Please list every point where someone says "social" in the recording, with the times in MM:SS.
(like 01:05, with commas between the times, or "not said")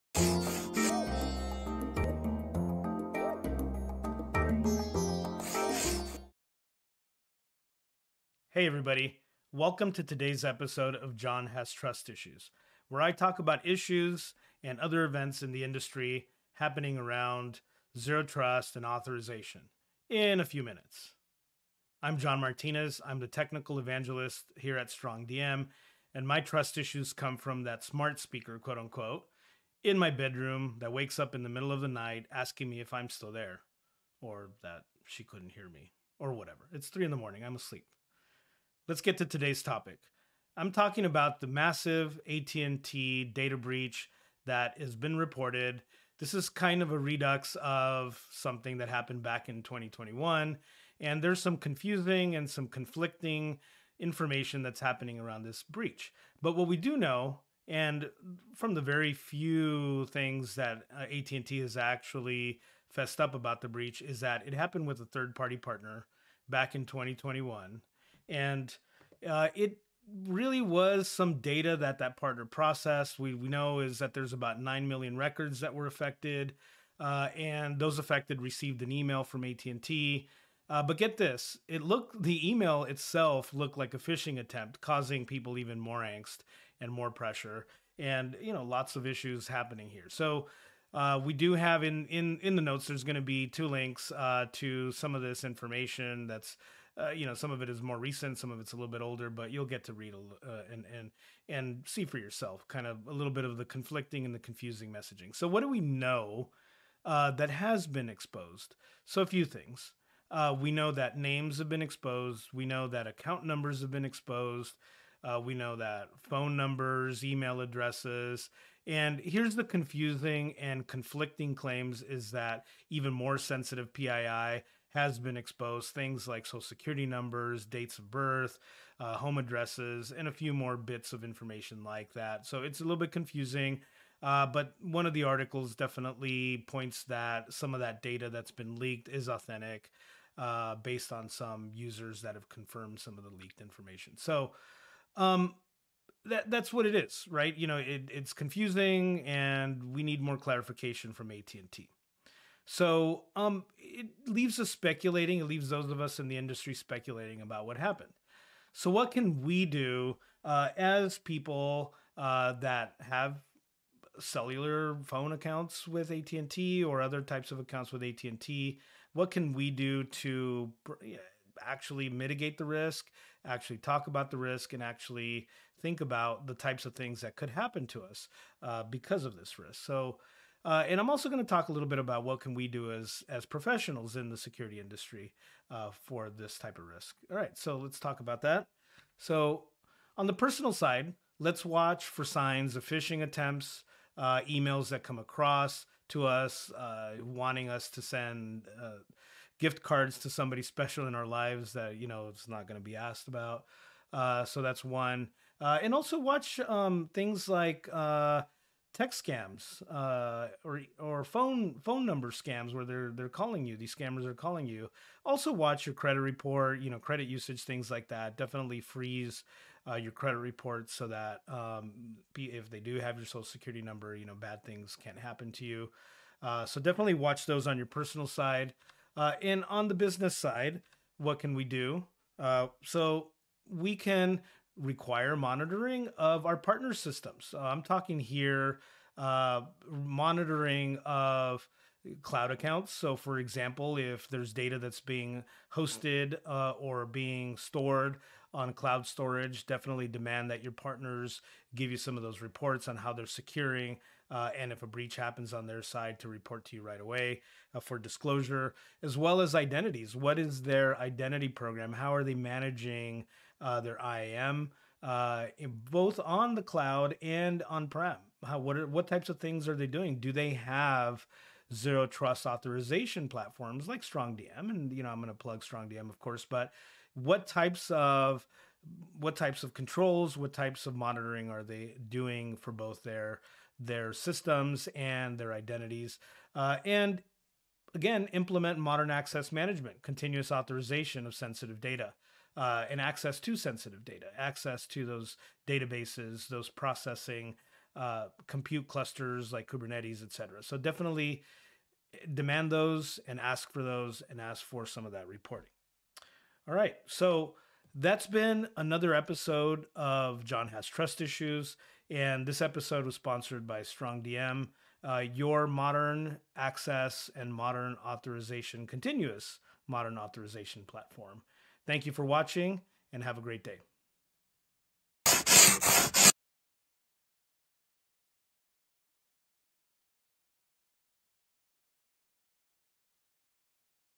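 02:06, 03:43.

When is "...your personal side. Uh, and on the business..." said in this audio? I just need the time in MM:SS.
03:47.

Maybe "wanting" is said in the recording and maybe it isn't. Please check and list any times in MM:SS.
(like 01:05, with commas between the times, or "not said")
03:17.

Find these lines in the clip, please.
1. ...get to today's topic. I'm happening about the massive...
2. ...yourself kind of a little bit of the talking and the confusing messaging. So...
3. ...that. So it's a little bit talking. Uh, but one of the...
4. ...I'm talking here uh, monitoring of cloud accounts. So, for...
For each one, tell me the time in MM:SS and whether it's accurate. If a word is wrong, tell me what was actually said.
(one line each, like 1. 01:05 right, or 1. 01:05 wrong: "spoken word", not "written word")
1. 00:38 wrong: "talking", not "happening"
2. 01:42 wrong: "conflicting", not "talking"
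3. 02:12 wrong: "confusing", not "talking"
4. 03:57 right.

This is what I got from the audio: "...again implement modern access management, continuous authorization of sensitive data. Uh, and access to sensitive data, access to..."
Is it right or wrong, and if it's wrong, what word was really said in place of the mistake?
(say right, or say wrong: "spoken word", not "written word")
right.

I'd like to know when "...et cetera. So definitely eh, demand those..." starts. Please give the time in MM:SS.
05:00.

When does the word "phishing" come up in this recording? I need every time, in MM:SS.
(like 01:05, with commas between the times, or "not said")
01:23, 03:12.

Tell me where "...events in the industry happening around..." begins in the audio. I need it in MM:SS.
00:15.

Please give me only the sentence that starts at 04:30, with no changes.
Do they have zero trust authorization platforms like StrongDM?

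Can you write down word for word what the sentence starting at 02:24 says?
So um, that that's what it is, right?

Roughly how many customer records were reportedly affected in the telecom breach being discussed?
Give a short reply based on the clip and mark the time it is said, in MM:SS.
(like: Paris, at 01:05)
9 million, at 01:14.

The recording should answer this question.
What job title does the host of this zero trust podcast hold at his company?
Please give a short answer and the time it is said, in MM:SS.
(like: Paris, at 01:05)
Technical evangelist, at 00:23.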